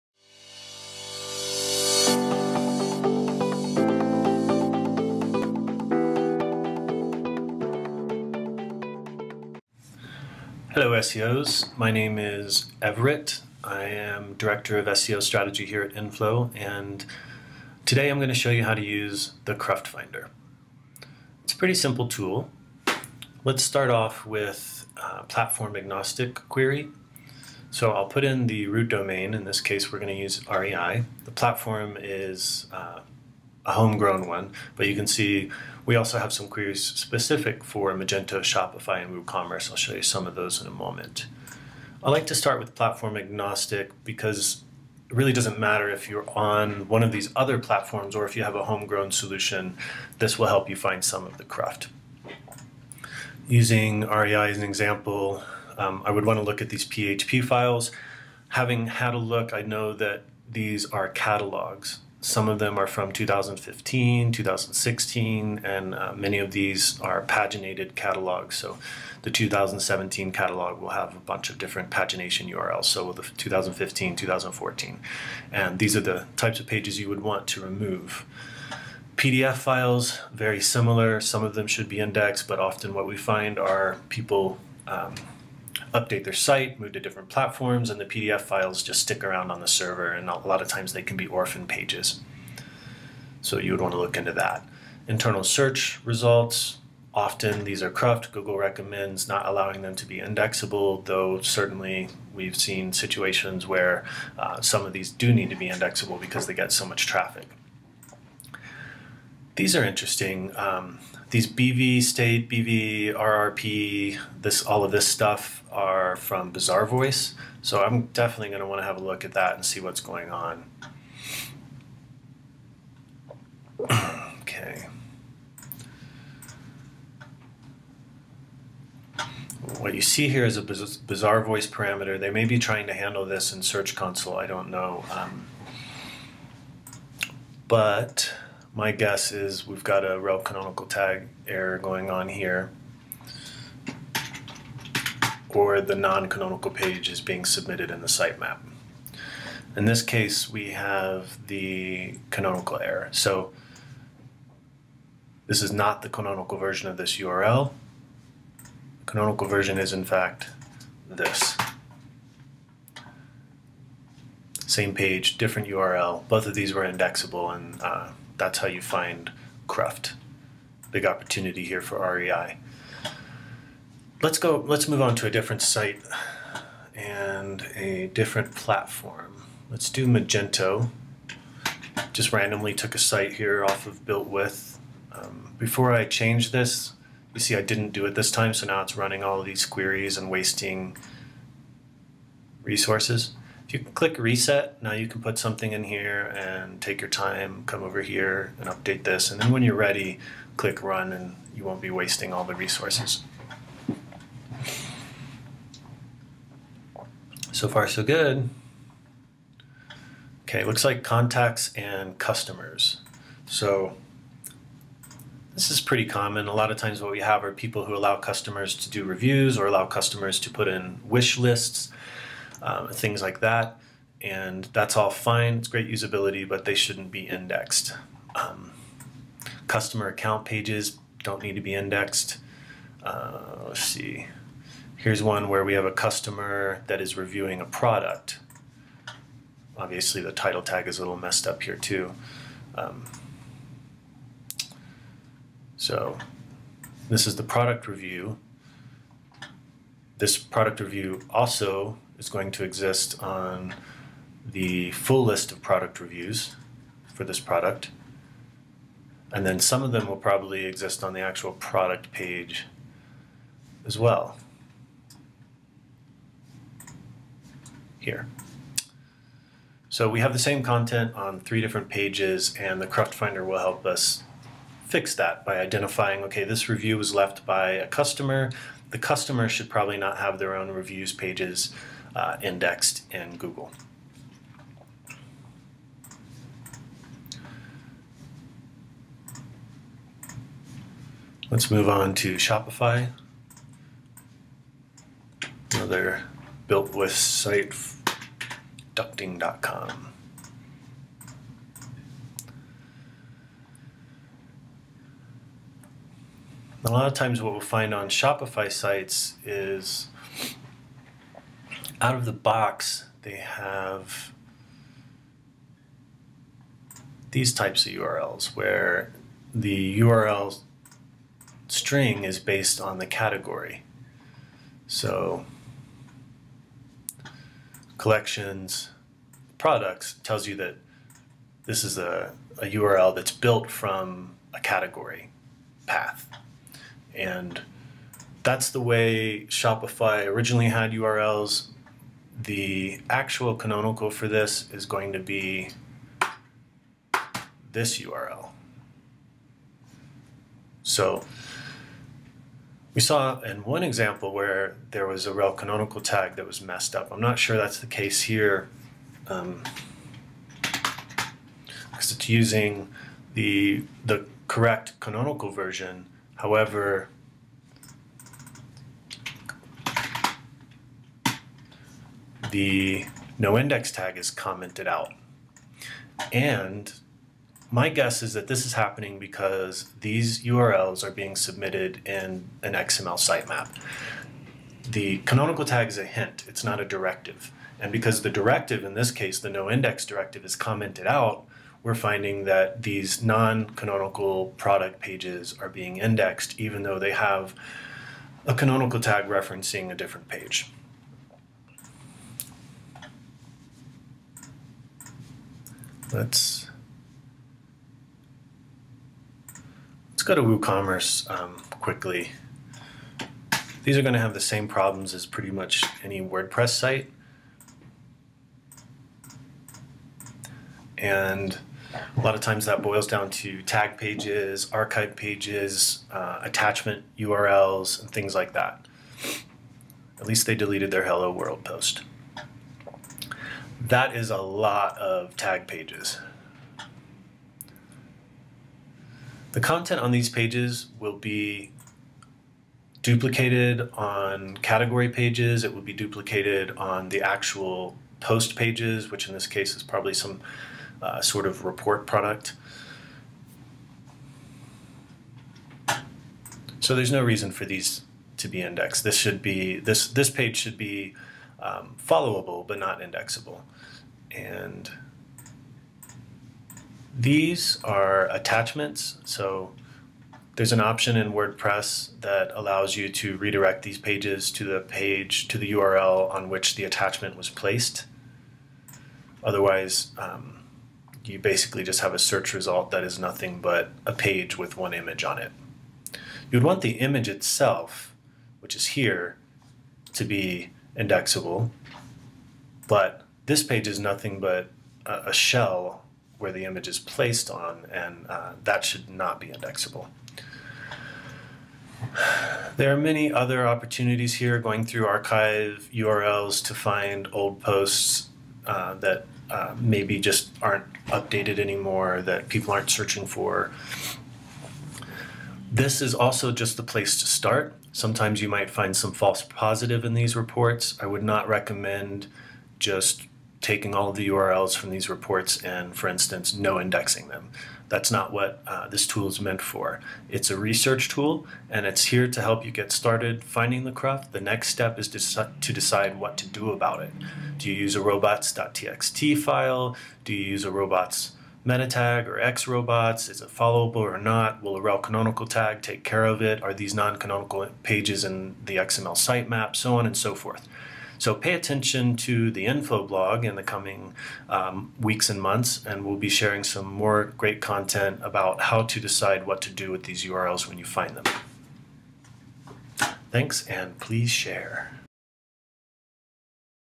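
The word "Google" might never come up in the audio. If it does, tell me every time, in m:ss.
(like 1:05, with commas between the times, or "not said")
1:38, 4:43.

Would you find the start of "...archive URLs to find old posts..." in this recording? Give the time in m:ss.
8:25.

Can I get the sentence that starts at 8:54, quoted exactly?
The next step is to, to decide what to do about it.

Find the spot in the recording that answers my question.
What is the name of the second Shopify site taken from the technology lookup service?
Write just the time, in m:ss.
4:58.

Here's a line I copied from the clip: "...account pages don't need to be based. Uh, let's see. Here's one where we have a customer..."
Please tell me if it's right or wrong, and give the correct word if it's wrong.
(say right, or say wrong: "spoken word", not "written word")
wrong: "indexed", not "based".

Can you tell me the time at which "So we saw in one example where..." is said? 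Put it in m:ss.
5:50.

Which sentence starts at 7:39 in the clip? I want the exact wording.
This should be this this page should be um, followable but not indexable.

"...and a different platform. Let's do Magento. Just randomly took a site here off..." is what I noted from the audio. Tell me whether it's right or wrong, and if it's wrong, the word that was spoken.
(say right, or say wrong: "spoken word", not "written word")
right.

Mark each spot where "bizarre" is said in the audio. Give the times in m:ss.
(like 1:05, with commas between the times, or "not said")
1:56, 2:10.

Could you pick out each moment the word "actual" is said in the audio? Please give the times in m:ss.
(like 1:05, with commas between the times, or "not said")
4:21, 5:43, 7:27.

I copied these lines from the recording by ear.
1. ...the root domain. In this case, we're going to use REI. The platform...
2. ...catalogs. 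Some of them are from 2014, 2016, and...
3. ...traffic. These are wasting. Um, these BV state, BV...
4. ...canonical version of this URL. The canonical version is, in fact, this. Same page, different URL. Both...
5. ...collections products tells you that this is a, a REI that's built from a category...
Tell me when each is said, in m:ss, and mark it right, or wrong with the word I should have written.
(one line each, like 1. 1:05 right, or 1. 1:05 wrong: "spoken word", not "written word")
1. 0:28 right
2. 1:01 wrong: "2015", not "2014"
3. 1:47 wrong: "interesting", not "wasting"
4. 2:36 right
5. 5:27 wrong: "URL", not "REI".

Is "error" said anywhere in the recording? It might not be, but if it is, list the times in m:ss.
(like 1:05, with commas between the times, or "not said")
2:21, 2:32.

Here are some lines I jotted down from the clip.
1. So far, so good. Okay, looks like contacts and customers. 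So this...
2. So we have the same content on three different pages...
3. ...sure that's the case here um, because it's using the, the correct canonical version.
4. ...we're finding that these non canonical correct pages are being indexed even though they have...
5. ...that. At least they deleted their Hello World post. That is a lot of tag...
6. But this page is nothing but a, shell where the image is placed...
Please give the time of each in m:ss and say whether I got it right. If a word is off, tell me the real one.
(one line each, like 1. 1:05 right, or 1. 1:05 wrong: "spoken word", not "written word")
1. 3:27 right
2. 4:29 right
3. 5:57 right
4. 6:31 wrong: "product", not "correct"
5. 7:08 right
6. 8:12 right.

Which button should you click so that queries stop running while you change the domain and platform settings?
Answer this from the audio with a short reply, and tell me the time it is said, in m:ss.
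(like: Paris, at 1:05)
reset, at 3:14.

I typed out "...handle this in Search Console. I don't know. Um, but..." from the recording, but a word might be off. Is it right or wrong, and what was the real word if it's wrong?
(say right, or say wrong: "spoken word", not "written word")
right.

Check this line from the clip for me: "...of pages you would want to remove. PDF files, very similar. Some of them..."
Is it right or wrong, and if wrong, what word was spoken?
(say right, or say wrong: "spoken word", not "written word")
right.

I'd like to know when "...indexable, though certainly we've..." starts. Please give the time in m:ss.
1:40.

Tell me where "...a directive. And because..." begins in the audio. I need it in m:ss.
6:26.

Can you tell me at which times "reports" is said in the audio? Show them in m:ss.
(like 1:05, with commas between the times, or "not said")
7:31, 8:40, 8:45.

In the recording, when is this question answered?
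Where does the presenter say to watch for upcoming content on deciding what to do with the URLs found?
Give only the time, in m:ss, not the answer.
9:12.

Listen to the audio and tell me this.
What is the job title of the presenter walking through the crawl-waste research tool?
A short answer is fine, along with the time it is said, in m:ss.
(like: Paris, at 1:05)
Director of SEO Strategy, at 0:14.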